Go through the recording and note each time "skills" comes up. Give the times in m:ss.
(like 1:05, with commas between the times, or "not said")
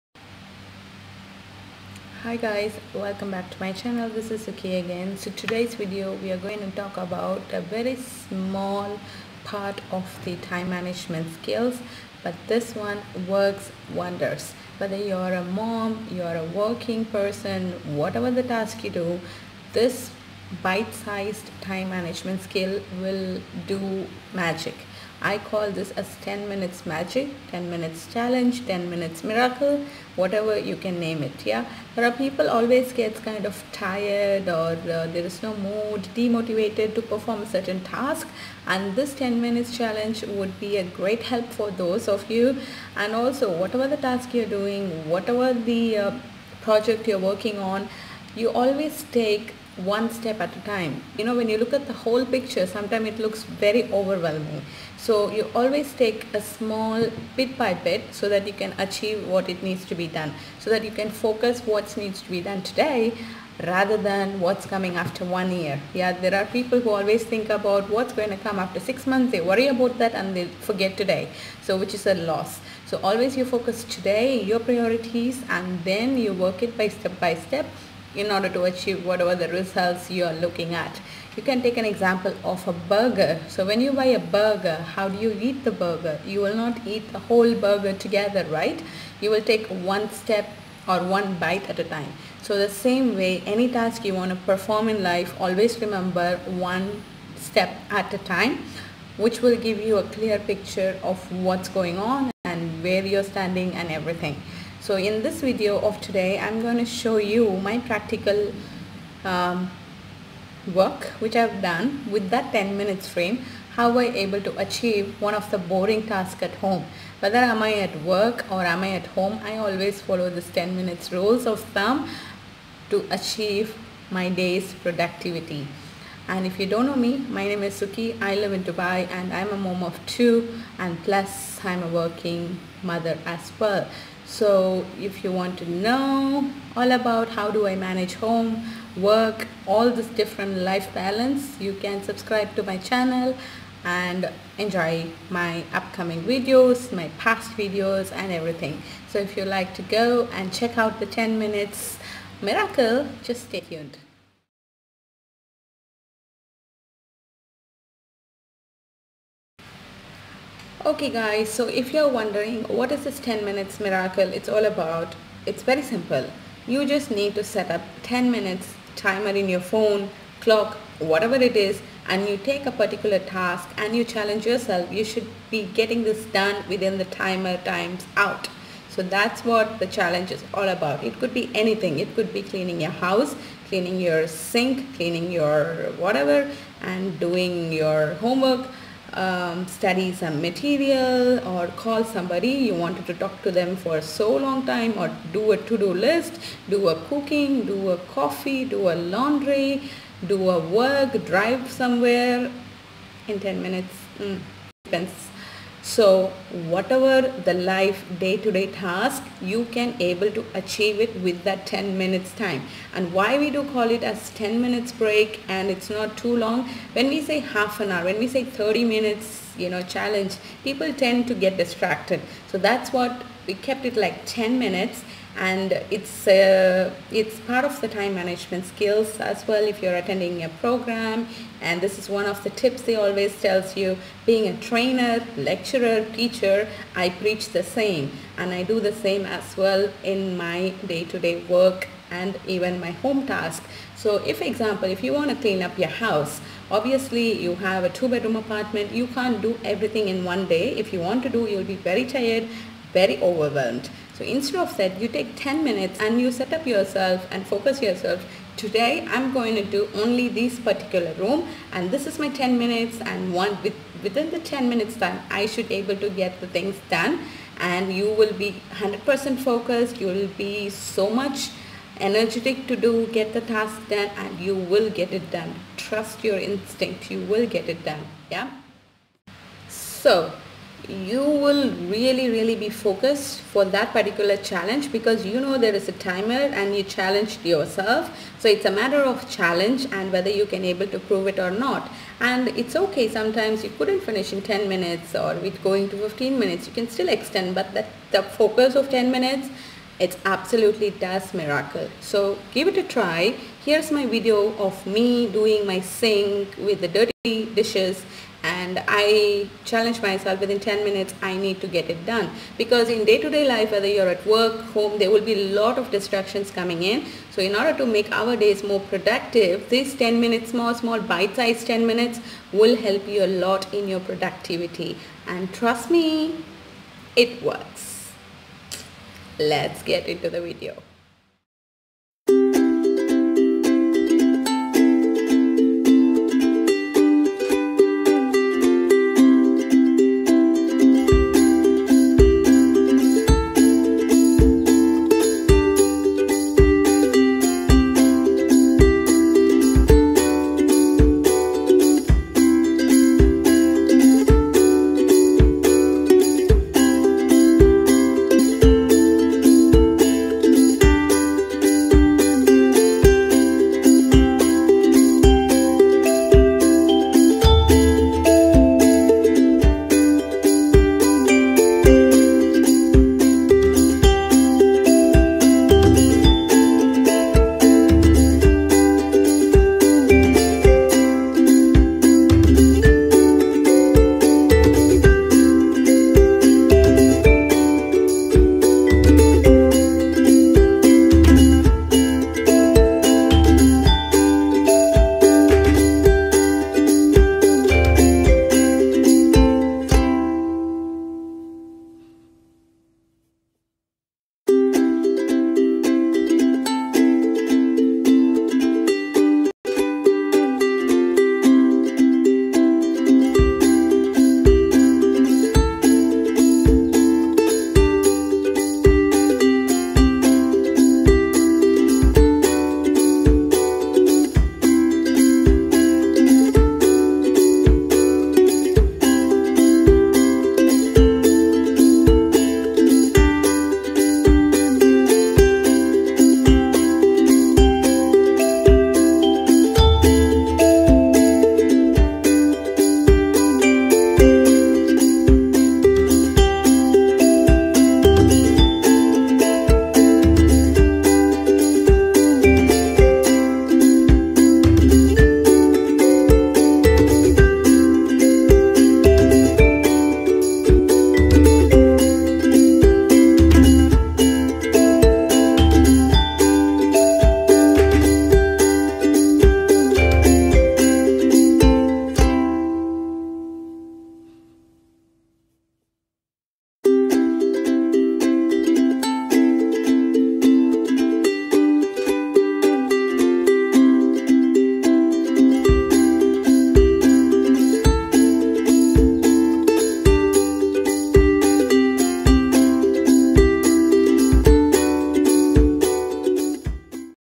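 0:11, 0:22, 3:48.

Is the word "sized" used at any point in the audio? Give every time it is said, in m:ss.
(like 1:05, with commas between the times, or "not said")
0:20, 5:21.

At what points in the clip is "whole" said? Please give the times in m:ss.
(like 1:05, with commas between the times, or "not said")
0:51, 1:27.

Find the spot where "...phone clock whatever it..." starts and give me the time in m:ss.
2:49.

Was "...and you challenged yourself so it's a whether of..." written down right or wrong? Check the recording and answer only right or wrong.
wrong.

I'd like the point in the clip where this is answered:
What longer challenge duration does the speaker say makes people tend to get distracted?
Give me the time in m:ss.
3:38.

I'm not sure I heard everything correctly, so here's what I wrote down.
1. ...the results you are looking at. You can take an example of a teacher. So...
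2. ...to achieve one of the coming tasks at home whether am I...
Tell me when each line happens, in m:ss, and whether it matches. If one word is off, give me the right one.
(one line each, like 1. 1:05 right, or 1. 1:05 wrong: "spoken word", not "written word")
1. 1:19 wrong: "burger", not "teacher"
2. 1:54 wrong: "boring", not "coming".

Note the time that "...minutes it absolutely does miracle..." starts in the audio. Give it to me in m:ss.
4:59.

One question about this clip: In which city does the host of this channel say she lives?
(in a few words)
Dubai.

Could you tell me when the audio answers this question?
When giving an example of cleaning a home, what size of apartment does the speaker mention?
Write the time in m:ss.
4:07.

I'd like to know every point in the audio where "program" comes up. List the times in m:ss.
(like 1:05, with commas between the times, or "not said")
3:50.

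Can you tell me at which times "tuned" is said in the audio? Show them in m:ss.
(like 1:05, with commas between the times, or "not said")
2:33.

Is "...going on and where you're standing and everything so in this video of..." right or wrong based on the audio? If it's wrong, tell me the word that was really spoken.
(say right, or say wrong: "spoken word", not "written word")
right.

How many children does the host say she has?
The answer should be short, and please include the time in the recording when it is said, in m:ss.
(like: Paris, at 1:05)
2, at 2:10.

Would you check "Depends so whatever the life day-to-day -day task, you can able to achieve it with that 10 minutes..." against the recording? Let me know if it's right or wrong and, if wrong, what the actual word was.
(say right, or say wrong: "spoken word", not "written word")
right.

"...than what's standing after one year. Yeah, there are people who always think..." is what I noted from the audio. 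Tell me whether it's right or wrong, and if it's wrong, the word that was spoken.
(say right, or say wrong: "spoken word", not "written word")
wrong: "coming", not "standing".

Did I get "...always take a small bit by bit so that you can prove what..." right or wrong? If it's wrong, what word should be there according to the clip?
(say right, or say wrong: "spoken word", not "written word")
wrong: "achieve", not "prove".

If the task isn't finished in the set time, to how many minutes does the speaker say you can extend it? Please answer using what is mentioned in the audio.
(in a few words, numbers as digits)
15 minutes.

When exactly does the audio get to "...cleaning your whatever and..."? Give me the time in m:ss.
3:04.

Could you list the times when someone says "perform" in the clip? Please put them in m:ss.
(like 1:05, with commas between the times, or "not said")
0:37, 1:34.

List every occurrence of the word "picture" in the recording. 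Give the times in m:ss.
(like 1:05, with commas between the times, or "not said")
0:52, 1:40.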